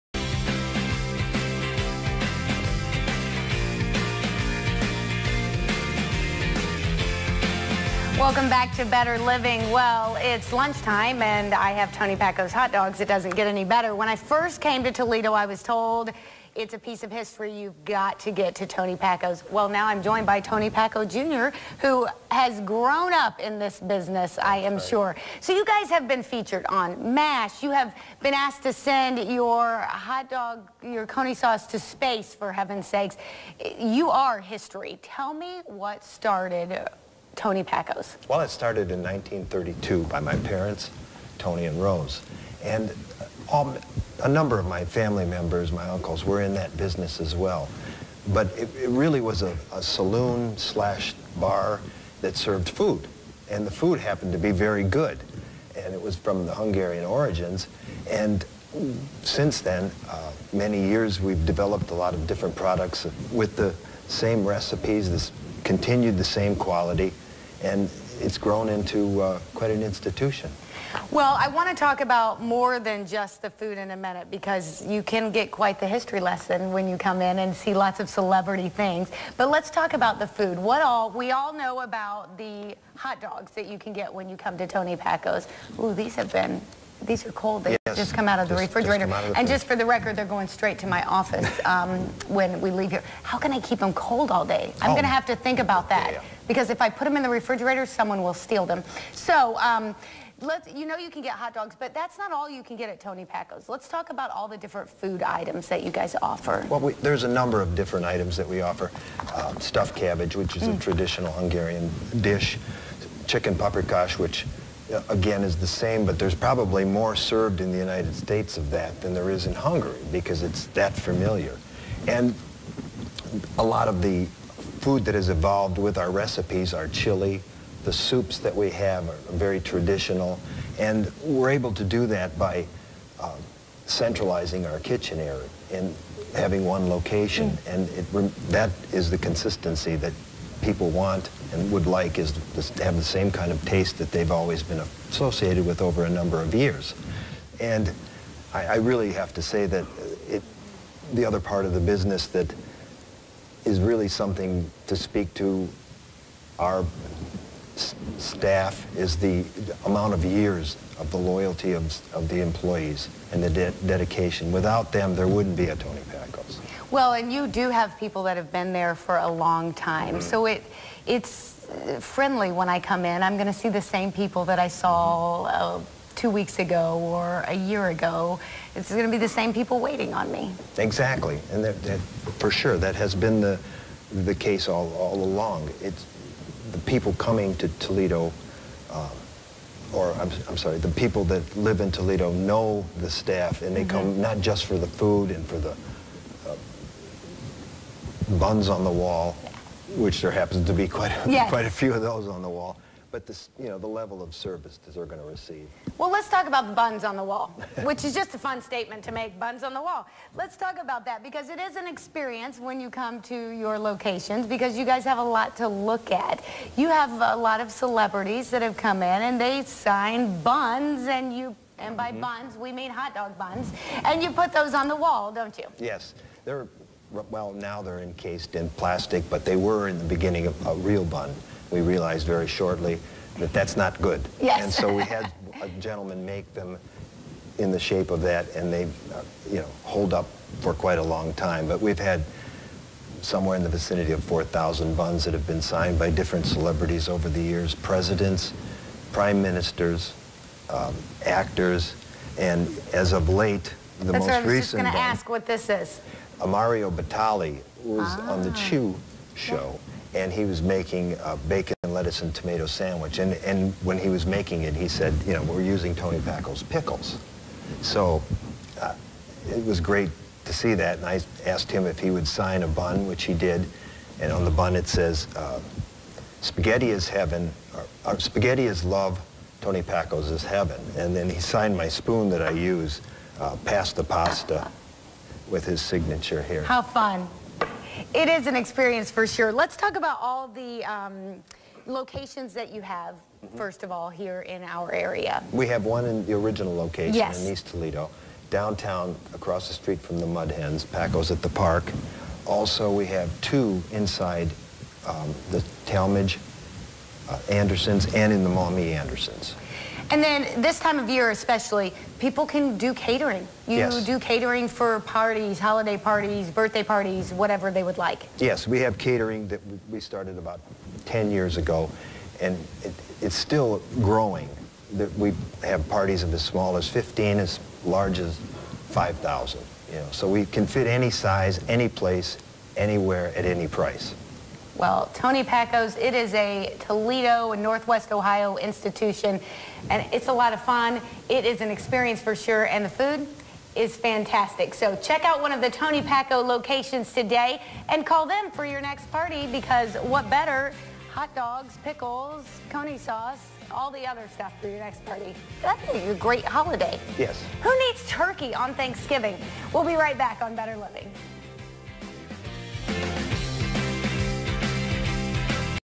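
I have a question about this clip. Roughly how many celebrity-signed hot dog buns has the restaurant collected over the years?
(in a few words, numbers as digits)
4,000.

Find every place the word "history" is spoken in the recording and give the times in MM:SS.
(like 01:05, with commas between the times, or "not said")
00:17, 00:34, 01:15.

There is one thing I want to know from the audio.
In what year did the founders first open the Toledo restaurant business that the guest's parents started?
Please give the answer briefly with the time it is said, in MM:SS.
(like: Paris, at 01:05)
1932, at 00:39.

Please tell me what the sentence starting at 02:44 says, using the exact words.
Without them, there wouldn't be a Tony Packo's.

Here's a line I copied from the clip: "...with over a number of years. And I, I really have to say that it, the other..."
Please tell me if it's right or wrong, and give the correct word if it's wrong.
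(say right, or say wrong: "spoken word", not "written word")
right.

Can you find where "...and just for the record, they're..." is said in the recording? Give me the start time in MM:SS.
01:29.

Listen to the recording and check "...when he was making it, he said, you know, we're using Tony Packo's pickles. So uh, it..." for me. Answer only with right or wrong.
right.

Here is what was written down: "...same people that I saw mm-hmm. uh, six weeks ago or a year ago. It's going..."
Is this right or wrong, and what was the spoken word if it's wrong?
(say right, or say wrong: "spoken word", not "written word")
wrong: "two", not "six".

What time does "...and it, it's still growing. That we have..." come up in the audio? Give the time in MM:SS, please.
05:22.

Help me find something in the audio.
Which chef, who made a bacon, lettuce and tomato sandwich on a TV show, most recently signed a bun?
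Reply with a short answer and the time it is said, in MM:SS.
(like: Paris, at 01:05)
Mario Batali, at 04:16.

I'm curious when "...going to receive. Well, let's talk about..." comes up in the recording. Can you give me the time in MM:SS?
03:25.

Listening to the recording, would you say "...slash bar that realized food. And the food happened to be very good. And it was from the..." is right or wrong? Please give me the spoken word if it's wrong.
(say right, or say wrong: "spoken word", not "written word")
wrong: "served", not "realized".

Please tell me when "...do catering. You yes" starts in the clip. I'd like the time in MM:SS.
05:12.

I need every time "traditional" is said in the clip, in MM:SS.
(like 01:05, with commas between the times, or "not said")
01:50, 02:09.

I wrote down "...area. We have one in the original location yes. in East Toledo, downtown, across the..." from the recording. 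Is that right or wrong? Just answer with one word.
right.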